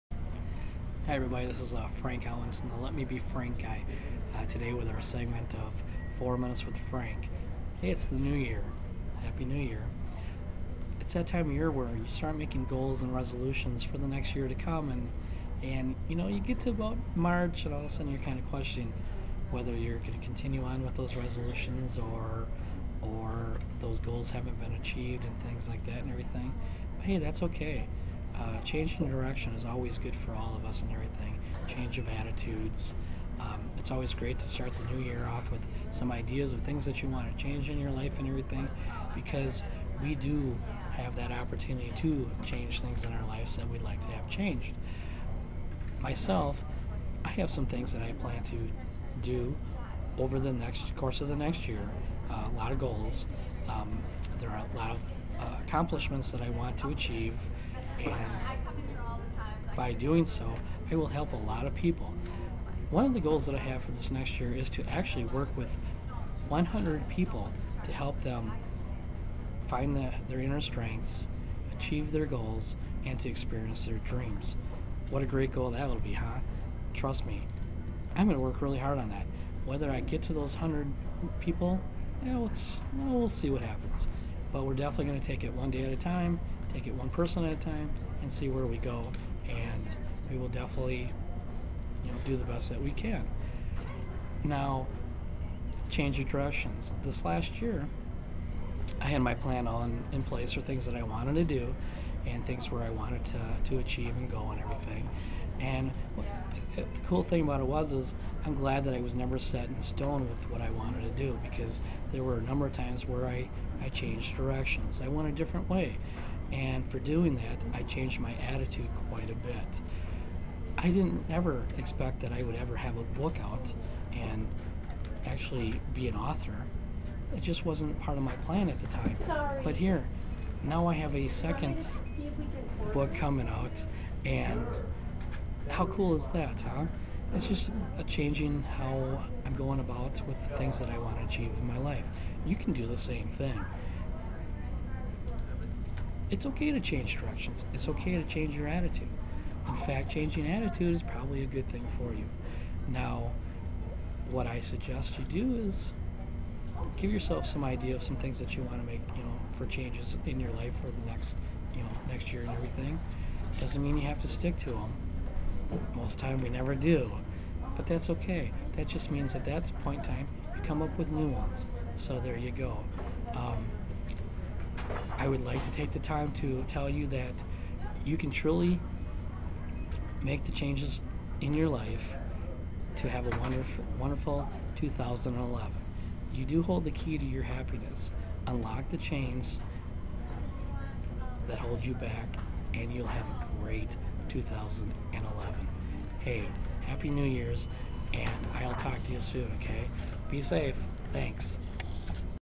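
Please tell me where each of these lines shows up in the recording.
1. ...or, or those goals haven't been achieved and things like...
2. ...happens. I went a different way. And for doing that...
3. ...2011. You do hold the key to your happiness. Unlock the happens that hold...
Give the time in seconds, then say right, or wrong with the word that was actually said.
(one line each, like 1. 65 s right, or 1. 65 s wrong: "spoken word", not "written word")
1. 21 s right
2. 114 s wrong: "directions", not "happens"
3. 184 s wrong: "chains", not "happens".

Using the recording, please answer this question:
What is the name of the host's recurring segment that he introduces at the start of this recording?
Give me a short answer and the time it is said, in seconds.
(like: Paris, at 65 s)
4 Minutes with Frank, at 6 s.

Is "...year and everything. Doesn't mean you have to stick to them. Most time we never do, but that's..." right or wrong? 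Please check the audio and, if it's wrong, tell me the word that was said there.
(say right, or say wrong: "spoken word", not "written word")
right.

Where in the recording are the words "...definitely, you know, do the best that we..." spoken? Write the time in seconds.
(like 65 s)
90 s.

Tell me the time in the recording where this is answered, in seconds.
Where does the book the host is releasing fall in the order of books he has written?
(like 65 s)
131 s.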